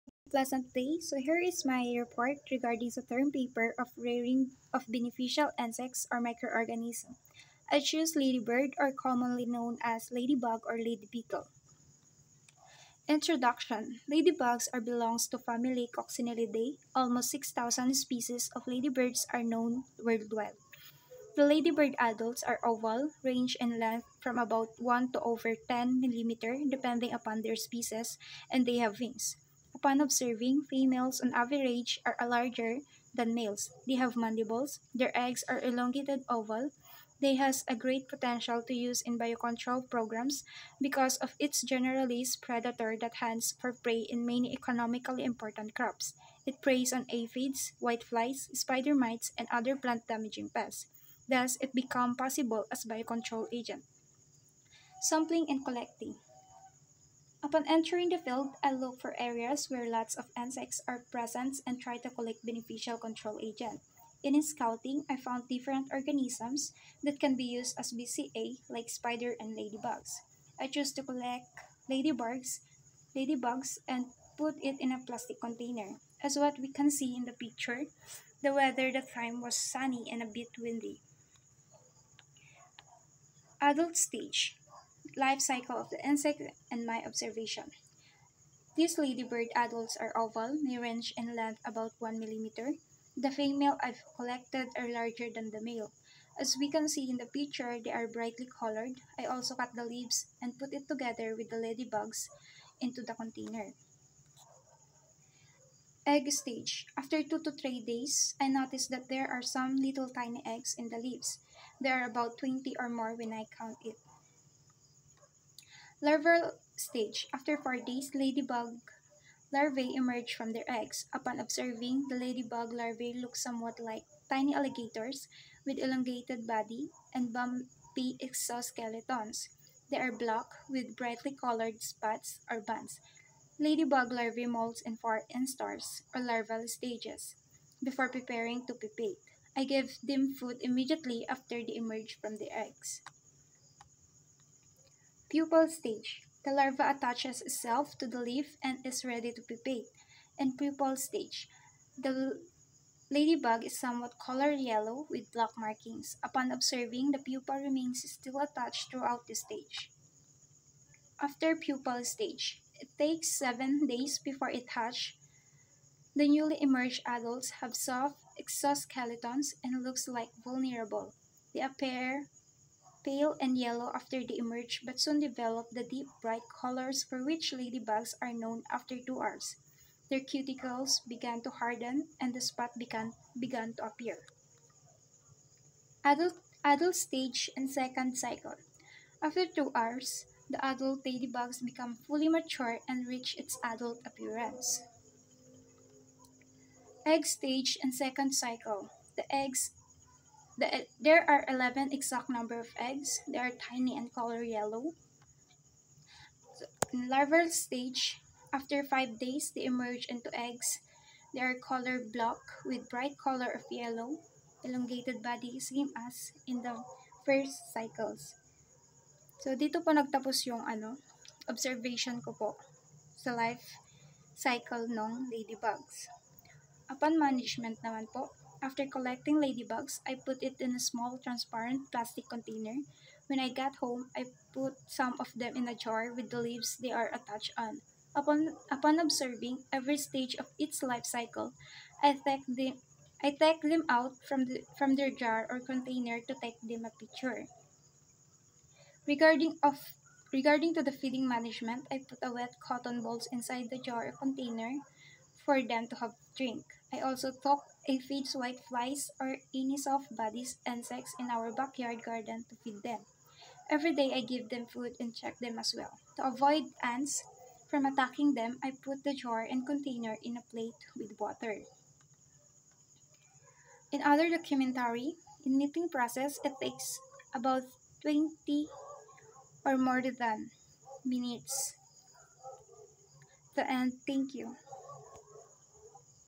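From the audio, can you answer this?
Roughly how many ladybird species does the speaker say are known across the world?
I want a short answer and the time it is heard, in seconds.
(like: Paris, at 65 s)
6,000, at 17 s.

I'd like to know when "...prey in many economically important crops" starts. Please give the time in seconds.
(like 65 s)
43 s.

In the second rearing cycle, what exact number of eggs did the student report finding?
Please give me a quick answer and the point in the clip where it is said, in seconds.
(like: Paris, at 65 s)
11, at 201 s.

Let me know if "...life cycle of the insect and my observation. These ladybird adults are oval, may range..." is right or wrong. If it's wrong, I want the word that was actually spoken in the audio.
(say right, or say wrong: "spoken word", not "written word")
right.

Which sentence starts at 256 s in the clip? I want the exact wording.
I also took it feeds whiteflies or any soft-bodied insects in our backyard garden to feed them.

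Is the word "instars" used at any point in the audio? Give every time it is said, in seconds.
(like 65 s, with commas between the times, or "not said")
135 s.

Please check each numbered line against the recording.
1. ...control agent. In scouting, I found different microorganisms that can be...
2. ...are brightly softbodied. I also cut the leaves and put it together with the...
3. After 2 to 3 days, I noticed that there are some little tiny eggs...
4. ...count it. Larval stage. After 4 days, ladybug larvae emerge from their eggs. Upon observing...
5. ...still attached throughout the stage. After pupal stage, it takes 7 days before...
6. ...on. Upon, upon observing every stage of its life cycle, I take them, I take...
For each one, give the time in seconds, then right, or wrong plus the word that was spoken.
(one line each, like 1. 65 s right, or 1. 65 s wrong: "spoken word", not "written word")
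1. 63 s wrong: "organisms", not "microorganisms"
2. 97 s wrong: "colored", not "softbodied"
3. 106 s right
4. 113 s right
5. 158 s right
6. 237 s right.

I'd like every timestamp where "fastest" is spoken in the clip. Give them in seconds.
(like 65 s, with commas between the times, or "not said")
not said.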